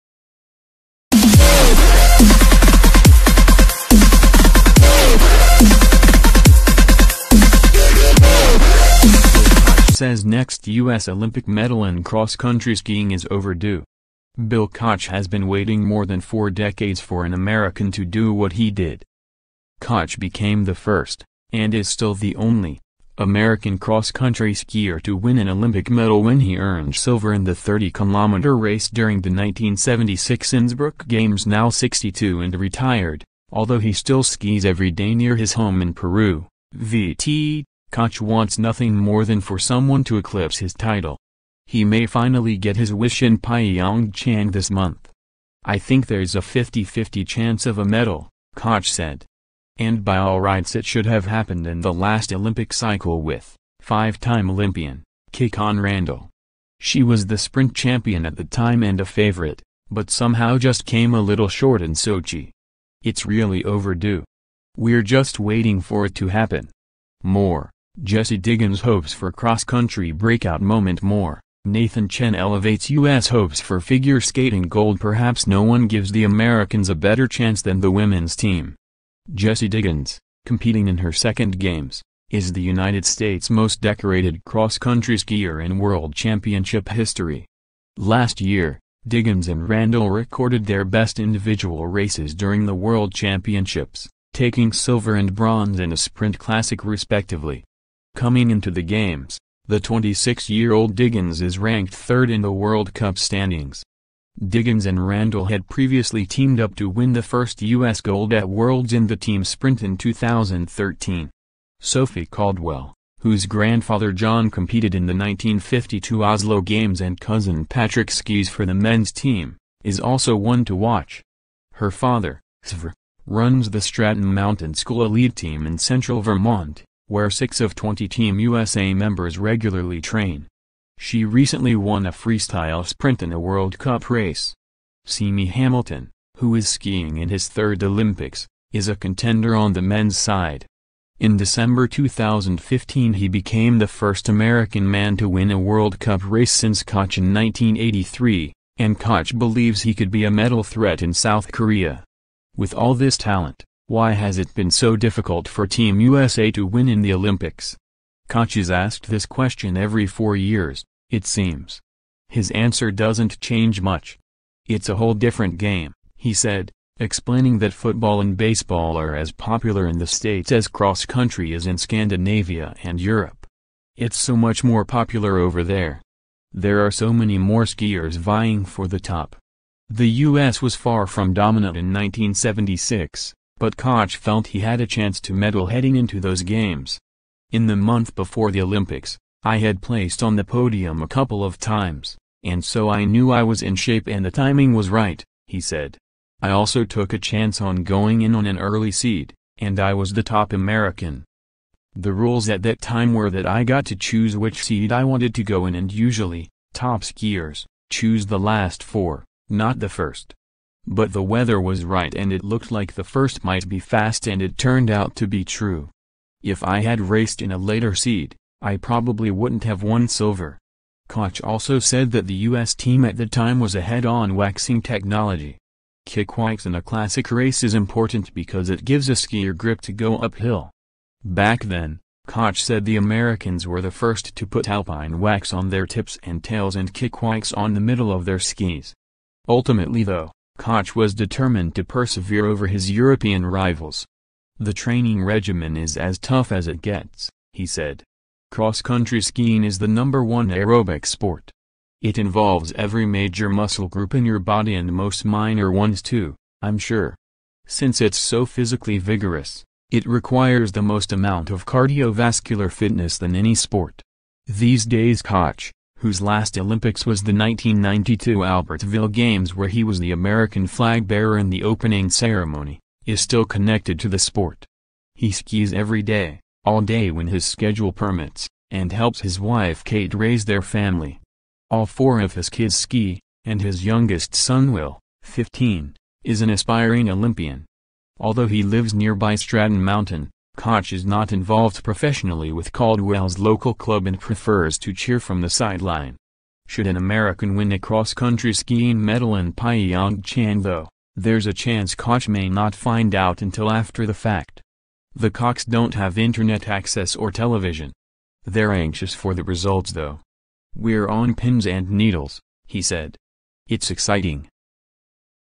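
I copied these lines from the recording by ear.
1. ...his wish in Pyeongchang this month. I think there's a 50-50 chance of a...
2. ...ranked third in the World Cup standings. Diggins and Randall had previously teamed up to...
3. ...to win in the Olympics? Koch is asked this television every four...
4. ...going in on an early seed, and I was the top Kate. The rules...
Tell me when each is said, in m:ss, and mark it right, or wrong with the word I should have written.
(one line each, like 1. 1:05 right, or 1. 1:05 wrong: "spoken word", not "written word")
1. 0:42 right
2. 1:41 right
3. 2:36 wrong: "question", not "television"
4. 3:17 wrong: "American", not "Kate".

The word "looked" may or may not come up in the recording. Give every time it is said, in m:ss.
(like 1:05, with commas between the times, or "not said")
3:32.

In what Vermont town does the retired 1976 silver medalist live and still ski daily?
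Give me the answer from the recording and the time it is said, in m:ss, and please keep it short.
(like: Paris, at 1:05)
Peru, at 0:35.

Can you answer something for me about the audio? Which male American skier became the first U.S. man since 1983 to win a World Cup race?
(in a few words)
Simi Hamilton.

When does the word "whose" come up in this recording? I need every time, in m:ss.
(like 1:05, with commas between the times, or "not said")
1:53, 4:26.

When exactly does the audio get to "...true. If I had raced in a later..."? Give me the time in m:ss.
3:35.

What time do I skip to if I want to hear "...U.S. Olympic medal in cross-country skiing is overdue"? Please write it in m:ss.
0:10.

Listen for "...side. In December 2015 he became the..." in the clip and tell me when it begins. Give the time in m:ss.
2:20.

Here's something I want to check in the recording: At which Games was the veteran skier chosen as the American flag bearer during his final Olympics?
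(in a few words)
1992 Albertville Games.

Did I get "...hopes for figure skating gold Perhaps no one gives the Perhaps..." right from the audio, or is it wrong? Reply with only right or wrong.
wrong.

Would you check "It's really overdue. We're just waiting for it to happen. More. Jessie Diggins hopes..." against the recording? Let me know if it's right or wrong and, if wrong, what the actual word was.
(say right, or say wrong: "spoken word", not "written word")
right.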